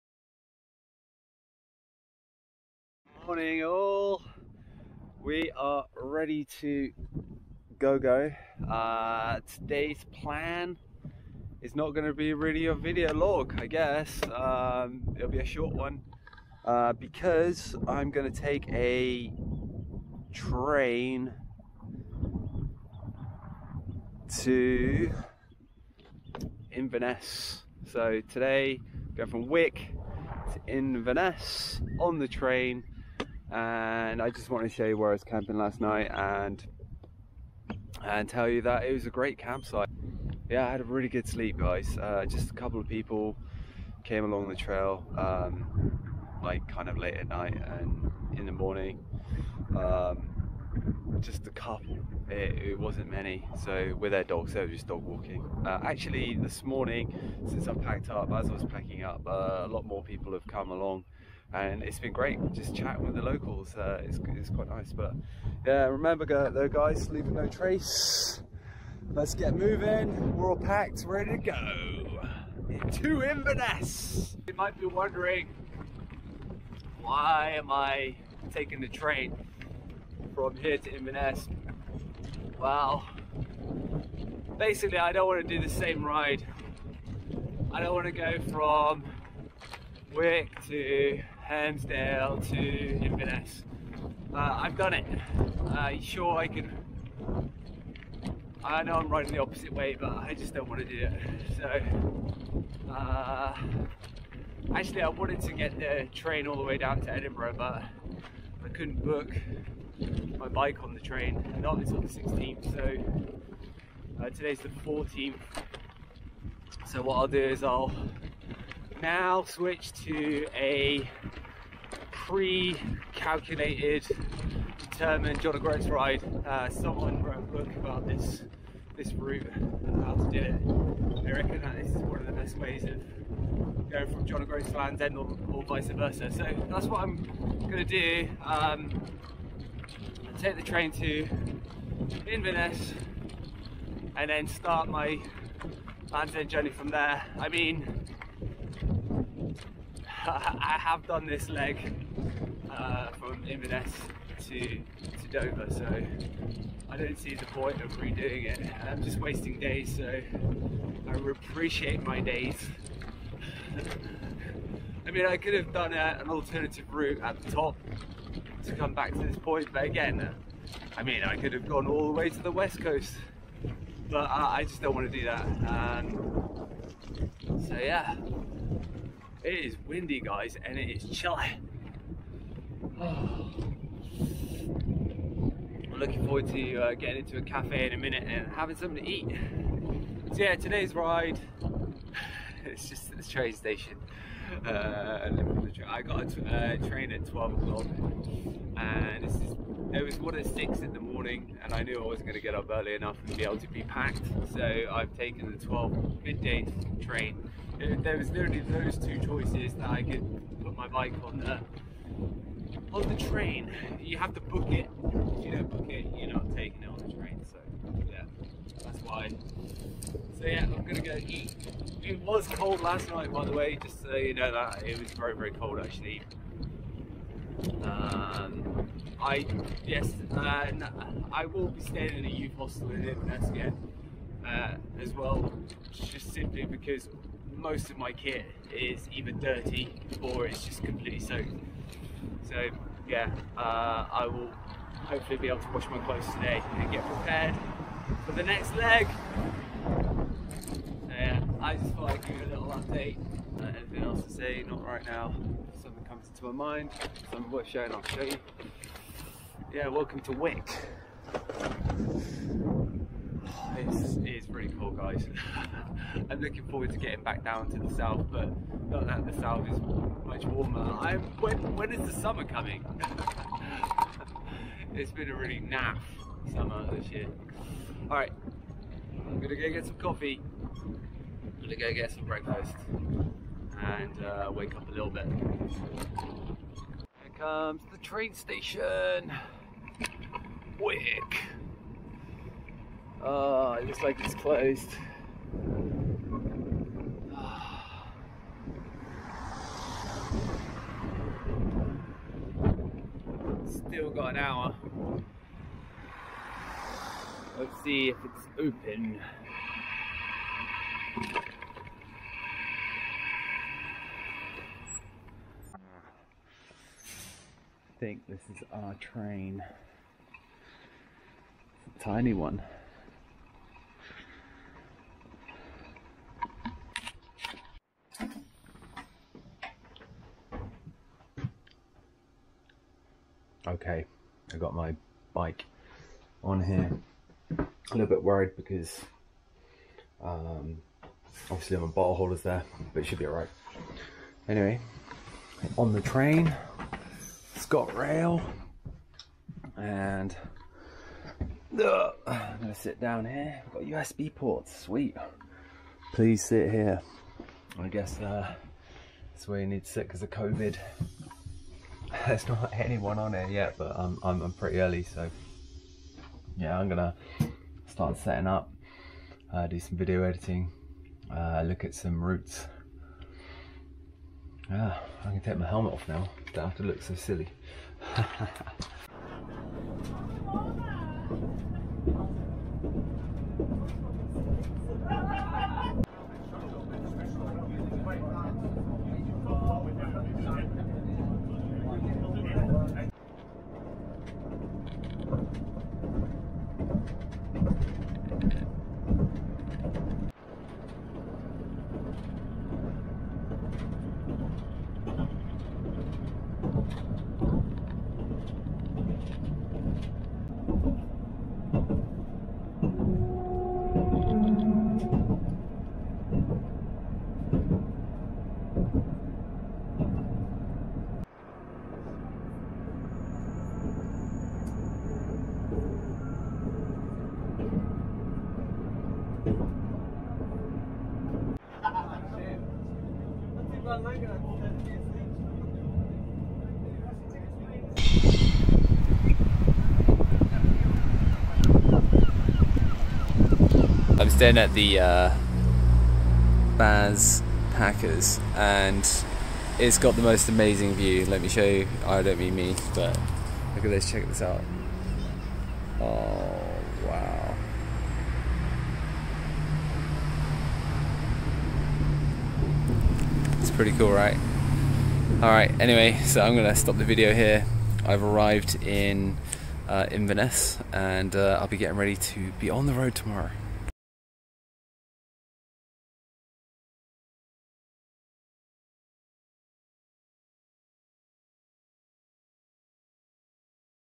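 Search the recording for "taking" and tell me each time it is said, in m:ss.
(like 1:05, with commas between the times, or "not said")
1:18, 3:36.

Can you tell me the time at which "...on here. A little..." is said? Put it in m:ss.
5:36.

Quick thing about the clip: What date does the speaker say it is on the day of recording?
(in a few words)
14th.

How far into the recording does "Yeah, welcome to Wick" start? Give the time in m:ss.
4:19.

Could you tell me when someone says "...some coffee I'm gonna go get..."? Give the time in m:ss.
4:39.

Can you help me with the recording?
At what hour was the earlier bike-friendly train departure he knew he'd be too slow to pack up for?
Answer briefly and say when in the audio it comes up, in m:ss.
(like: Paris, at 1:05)
6, at 3:20.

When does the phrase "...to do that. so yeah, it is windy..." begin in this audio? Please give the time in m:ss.
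2:55.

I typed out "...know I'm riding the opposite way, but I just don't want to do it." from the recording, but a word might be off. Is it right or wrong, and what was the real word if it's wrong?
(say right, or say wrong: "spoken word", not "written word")
right.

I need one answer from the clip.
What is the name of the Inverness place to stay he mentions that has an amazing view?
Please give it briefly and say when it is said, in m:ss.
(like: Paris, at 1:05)
Baz Packers, at 7:26.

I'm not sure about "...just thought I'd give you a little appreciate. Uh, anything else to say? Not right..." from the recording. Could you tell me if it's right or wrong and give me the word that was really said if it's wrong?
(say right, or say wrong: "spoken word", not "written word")
wrong: "update", not "appreciate".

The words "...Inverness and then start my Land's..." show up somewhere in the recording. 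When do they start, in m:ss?
2:22.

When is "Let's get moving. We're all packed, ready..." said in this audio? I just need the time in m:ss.
1:09.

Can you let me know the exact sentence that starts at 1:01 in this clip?
And it's been great just chatting with the locals.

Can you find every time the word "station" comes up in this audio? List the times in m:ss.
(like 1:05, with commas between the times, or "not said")
3:13, 4:48.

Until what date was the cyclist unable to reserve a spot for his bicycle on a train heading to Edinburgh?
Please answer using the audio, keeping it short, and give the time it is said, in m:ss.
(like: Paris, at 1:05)
16th, at 1:52.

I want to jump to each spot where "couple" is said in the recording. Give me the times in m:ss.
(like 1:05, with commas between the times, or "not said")
0:42, 0:51.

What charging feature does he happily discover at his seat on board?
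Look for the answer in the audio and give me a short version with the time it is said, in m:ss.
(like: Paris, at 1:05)
USB ports, at 5:53.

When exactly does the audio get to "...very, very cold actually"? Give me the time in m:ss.
3:45.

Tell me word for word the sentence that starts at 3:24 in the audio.
So I've taken the 12 midday train.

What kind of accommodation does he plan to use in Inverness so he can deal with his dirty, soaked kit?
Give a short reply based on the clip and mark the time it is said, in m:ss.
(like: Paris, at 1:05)
youth hostel, at 3:52.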